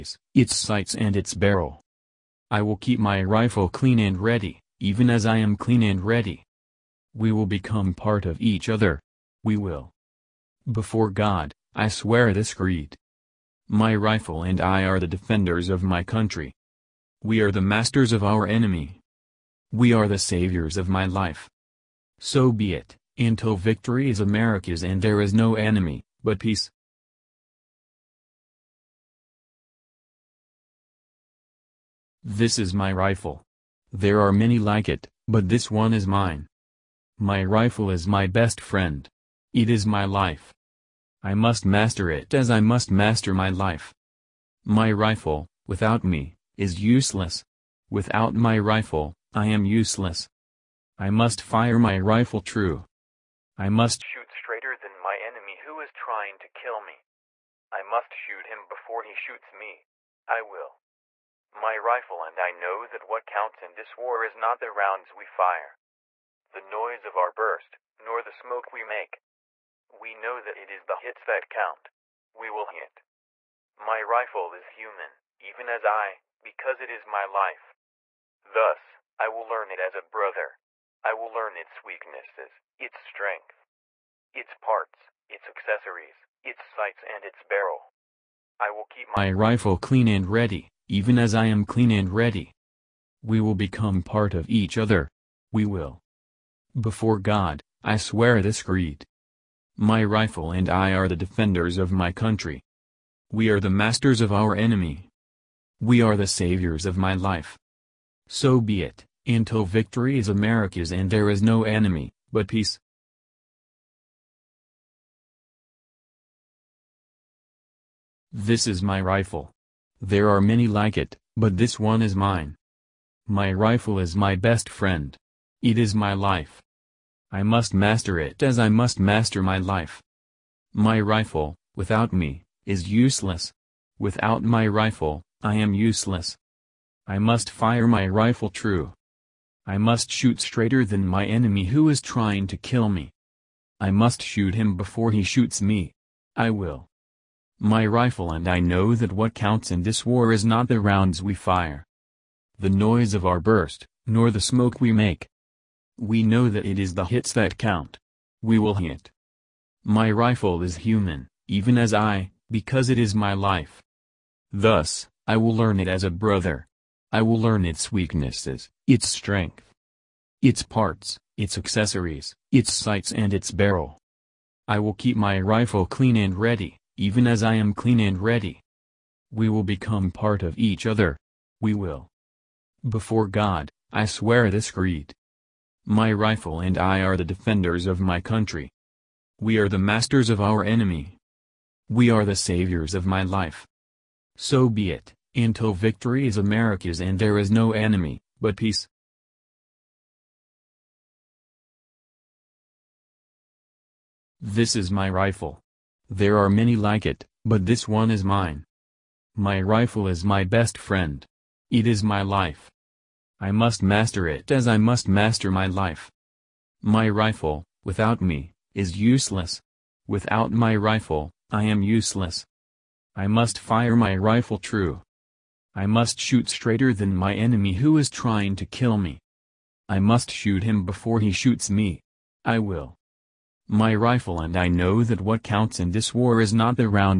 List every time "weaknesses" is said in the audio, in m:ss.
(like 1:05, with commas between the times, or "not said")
1:21, 2:47.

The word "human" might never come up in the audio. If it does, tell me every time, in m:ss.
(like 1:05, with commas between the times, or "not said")
1:14, 2:40.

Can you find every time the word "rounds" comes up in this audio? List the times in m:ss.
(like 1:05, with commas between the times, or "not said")
1:04, 2:30.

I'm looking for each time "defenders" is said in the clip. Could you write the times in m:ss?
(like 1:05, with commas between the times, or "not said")
0:15, 1:41, 3:07.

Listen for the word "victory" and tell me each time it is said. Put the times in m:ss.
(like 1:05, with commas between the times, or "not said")
0:23, 1:49, 3:15.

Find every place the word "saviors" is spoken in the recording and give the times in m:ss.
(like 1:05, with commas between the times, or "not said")
0:20, 1:46, 3:12.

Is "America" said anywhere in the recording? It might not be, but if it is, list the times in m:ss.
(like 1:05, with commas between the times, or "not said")
0:24, 1:50, 3:16.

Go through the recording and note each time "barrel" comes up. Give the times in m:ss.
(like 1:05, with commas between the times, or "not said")
0:01, 1:27, 2:53.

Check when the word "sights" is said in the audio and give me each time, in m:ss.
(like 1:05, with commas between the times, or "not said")
0:00, 1:26, 2:52.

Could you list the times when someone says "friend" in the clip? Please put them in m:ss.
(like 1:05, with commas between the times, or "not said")
0:38, 2:04, 3:30.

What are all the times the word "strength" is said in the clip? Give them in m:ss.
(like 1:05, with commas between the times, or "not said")
1:22, 2:49.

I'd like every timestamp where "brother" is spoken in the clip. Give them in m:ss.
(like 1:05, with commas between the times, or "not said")
1:20, 2:46.